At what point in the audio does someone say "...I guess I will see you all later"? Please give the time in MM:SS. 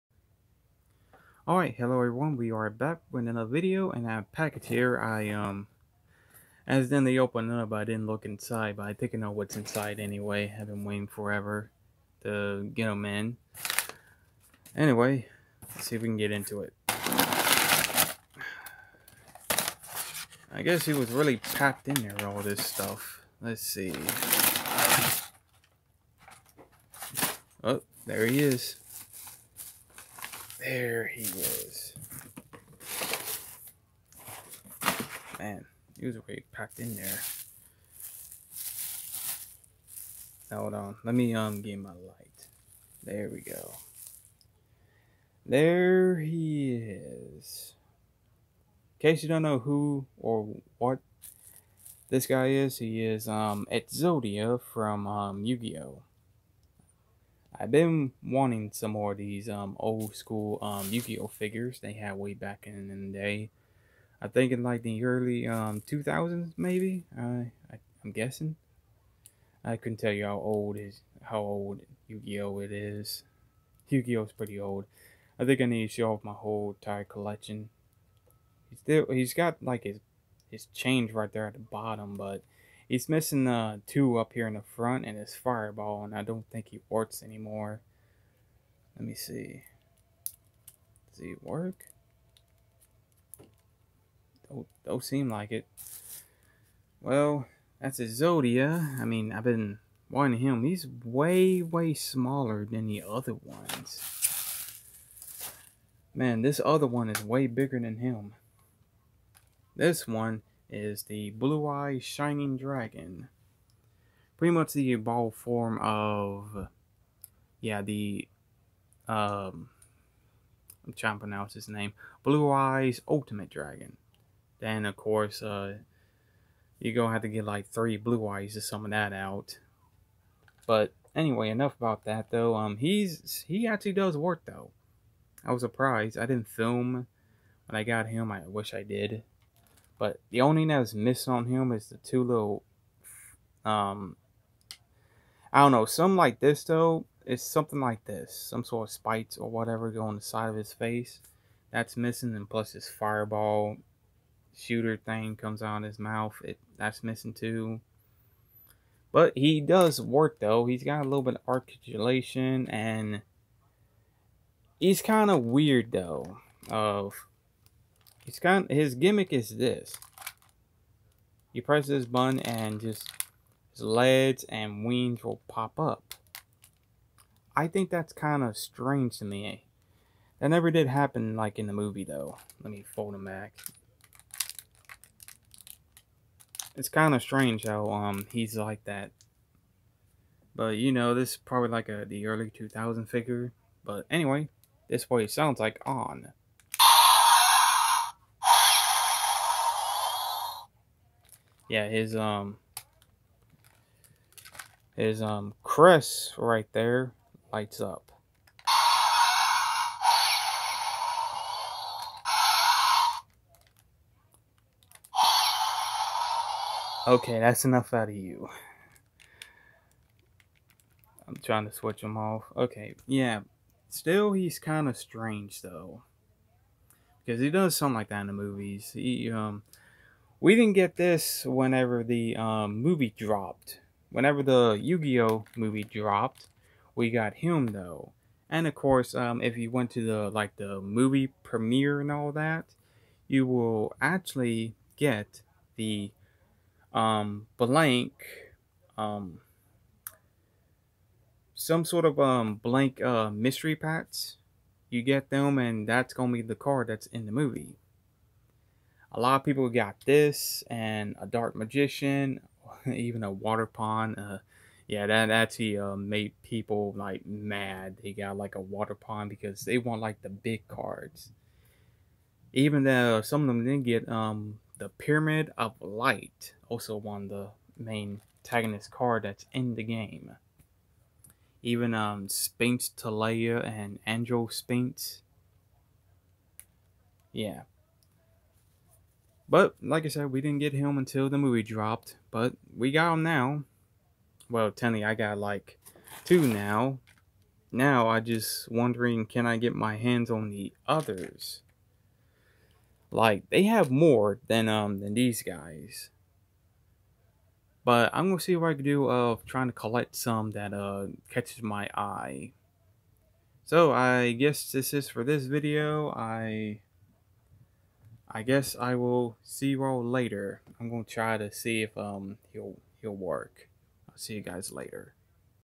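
05:18.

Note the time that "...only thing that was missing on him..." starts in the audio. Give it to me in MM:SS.
02:20.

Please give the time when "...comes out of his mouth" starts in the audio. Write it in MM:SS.
02:35.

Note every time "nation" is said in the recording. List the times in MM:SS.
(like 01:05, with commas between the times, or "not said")
not said.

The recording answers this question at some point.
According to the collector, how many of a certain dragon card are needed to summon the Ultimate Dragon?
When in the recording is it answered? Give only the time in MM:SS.
02:07.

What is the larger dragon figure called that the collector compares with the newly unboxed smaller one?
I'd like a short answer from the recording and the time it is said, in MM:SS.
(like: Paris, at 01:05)
Blue Eye Shining Dragon, at 01:51.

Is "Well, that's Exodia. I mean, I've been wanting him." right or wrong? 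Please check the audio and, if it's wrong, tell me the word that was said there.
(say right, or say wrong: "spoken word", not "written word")
right.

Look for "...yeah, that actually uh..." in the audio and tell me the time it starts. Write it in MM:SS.
04:24.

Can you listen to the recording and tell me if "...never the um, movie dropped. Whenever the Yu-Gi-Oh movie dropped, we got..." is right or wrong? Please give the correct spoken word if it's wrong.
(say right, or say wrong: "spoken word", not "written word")
wrong: "whenever", not "never".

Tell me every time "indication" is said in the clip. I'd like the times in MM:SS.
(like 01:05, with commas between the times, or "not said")
not said.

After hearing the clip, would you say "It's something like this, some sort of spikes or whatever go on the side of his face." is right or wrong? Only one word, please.
right.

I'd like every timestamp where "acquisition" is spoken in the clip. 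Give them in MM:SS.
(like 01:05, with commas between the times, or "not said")
not said.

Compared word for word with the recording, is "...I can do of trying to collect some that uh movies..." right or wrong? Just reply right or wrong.
wrong.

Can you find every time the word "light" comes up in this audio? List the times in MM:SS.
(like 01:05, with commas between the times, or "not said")
00:41, 03:27, 04:35.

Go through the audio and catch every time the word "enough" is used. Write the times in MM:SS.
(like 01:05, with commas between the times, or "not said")
02:11, 03:37.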